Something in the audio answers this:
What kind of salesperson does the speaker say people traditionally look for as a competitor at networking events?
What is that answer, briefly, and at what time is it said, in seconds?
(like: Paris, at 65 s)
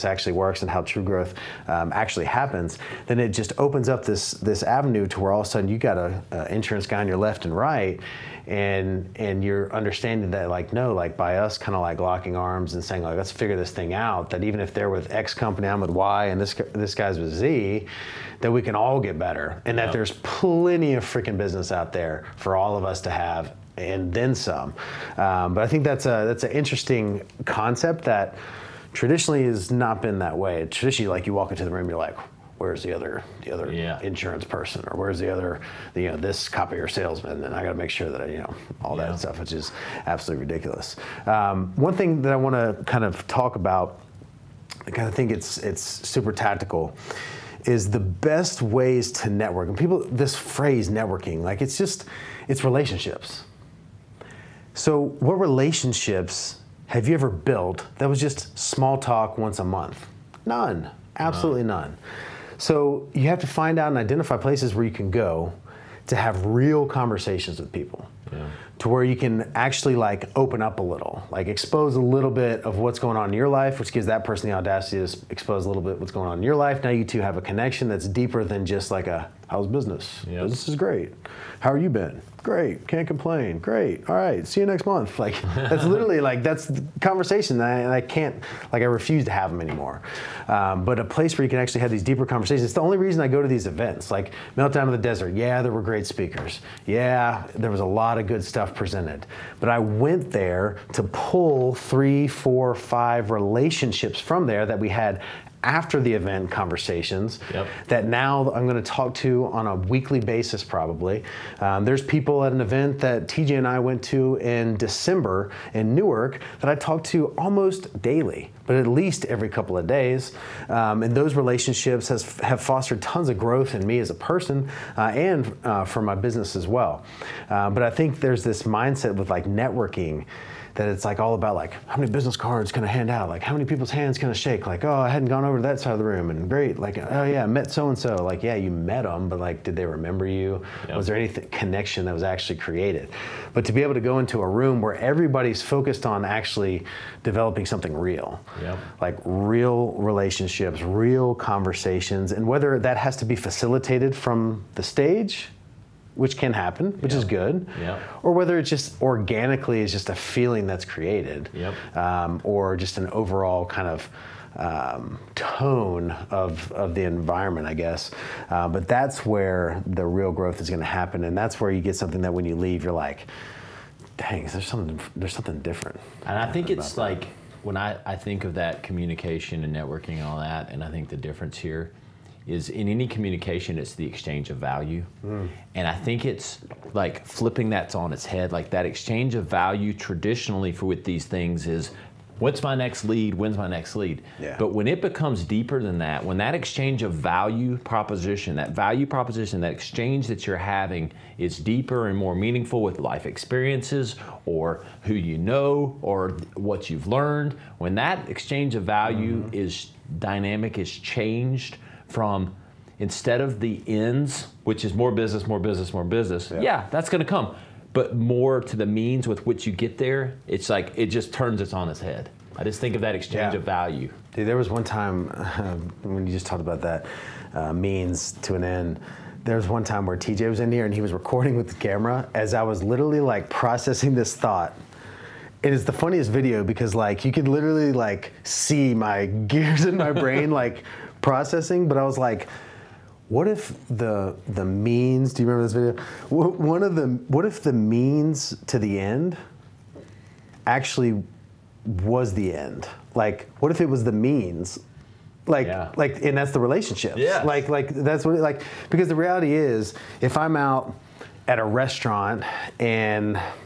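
copier salesman, at 36 s.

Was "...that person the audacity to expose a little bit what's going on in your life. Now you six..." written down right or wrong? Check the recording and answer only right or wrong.
wrong.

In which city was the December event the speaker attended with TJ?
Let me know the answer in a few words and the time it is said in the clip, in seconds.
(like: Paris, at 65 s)
Newark, at 115 s.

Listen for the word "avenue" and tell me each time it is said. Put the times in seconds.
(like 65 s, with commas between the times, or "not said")
4 s.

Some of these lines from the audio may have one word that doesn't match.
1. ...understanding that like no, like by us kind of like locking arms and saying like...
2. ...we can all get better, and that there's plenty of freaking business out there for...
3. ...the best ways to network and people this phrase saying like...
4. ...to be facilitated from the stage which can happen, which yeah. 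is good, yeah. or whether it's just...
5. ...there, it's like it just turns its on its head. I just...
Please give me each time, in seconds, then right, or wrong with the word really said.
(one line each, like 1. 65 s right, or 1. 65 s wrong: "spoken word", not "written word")
1. 9 s right
2. 18 s right
3. 47 s wrong: "networking", not "saying"
4. 153 s right
5. 219 s right.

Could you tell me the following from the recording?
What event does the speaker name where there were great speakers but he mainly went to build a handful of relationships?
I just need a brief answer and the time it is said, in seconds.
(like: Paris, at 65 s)
Meltdown of the Desert, at 94 s.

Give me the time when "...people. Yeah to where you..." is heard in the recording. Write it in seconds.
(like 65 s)
67 s.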